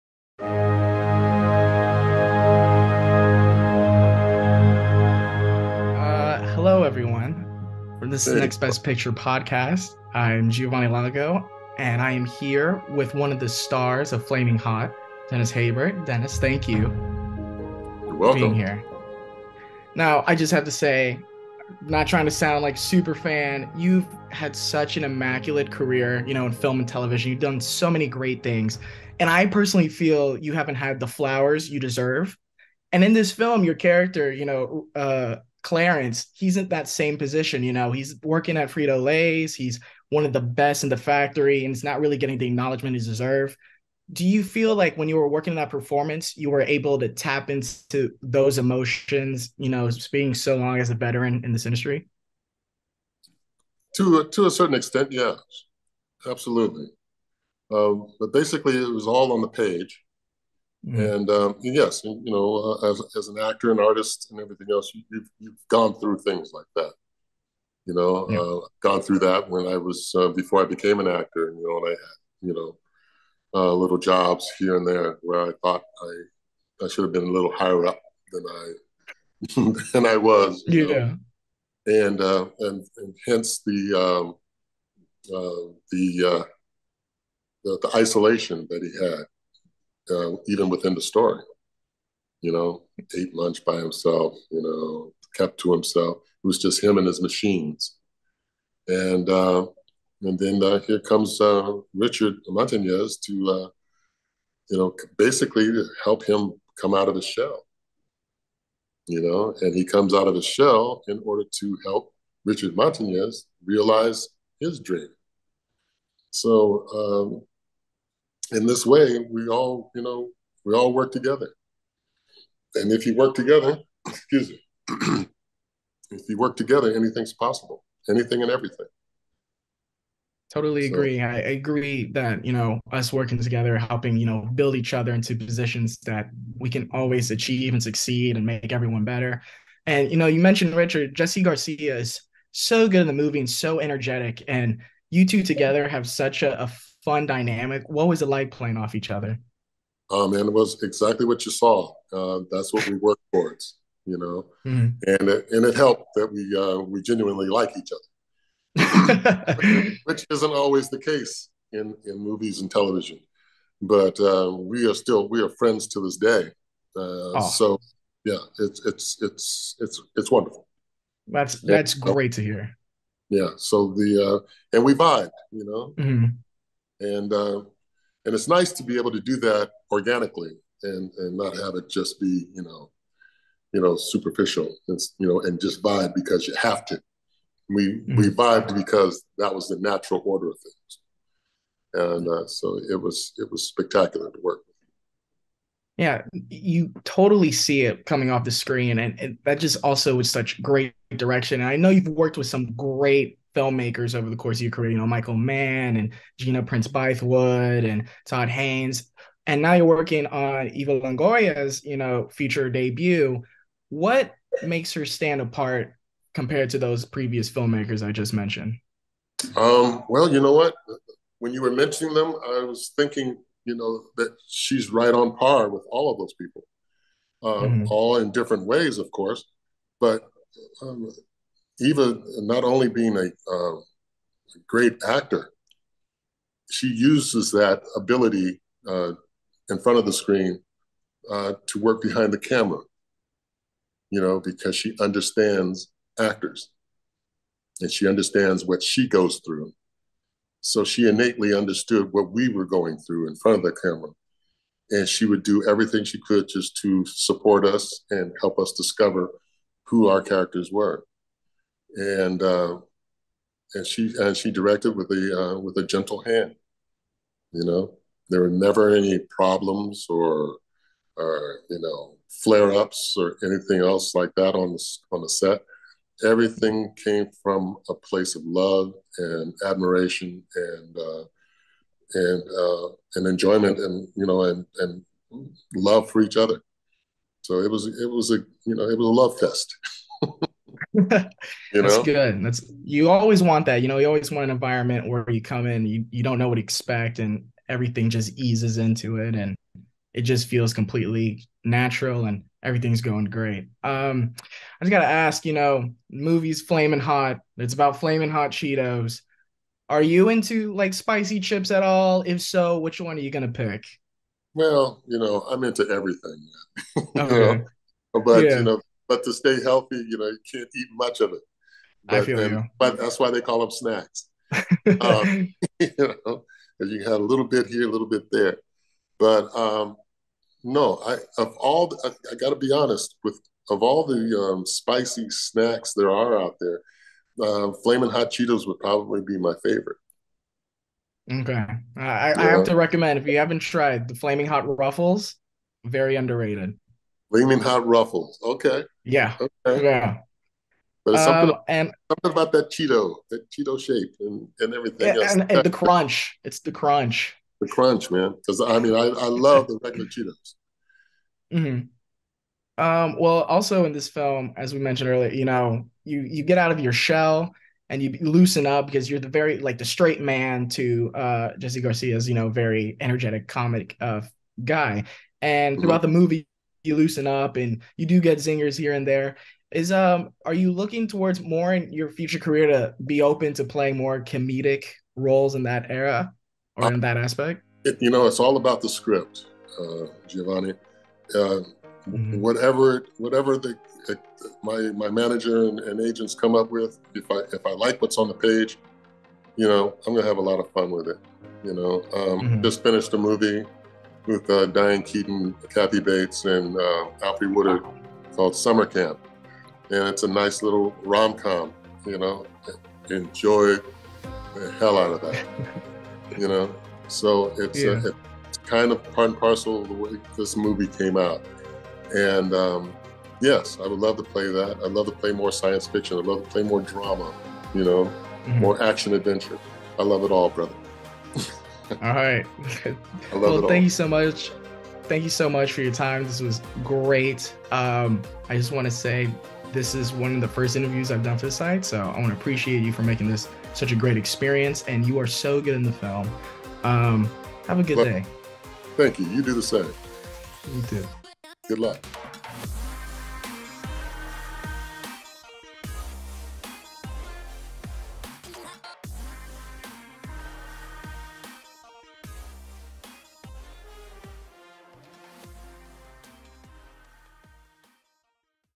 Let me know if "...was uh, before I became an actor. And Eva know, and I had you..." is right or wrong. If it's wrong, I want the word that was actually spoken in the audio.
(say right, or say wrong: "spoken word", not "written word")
wrong: "You", not "Eva".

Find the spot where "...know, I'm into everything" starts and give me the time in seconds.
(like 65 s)
315 s.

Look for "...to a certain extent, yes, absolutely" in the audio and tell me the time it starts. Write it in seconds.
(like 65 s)
54 s.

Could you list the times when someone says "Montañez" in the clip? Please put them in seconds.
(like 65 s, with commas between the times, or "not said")
102 s, 112 s.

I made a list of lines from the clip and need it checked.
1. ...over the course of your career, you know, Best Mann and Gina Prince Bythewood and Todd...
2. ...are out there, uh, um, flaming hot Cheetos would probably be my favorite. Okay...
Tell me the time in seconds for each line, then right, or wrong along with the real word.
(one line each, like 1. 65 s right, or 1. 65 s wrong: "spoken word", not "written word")
1. 204 s wrong: "Michael", not "Best"
2. 336 s right.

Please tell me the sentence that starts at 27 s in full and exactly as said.
You've done so many great things.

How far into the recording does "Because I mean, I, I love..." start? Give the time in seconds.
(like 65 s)
358 s.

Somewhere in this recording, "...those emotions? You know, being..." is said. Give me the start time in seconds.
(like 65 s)
48 s.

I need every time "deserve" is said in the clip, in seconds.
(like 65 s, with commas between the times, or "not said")
31 s, 43 s.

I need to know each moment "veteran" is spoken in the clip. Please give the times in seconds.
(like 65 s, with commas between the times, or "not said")
50 s.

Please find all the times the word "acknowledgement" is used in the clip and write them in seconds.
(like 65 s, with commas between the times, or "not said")
42 s.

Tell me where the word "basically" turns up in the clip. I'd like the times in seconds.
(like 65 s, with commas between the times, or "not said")
58 s, 105 s.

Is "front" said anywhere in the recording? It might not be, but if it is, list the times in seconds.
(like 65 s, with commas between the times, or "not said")
239 s, 253 s.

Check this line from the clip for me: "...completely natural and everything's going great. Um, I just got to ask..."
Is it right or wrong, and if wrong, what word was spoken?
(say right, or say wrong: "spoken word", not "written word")
right.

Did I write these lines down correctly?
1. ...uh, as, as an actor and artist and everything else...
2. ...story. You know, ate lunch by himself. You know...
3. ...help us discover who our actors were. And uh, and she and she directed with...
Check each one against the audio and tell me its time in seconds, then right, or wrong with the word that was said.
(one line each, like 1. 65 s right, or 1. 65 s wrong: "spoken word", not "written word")
1. 62 s right
2. 91 s right
3. 258 s wrong: "characters", not "actors".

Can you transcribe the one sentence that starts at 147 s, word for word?
What was it like playing off each other?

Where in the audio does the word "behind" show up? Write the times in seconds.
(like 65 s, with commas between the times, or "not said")
242 s.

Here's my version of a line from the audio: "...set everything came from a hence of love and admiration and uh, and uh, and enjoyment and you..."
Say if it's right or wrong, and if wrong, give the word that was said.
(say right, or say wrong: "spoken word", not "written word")
wrong: "place", not "hence".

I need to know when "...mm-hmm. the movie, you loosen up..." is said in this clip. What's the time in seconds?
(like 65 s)
376 s.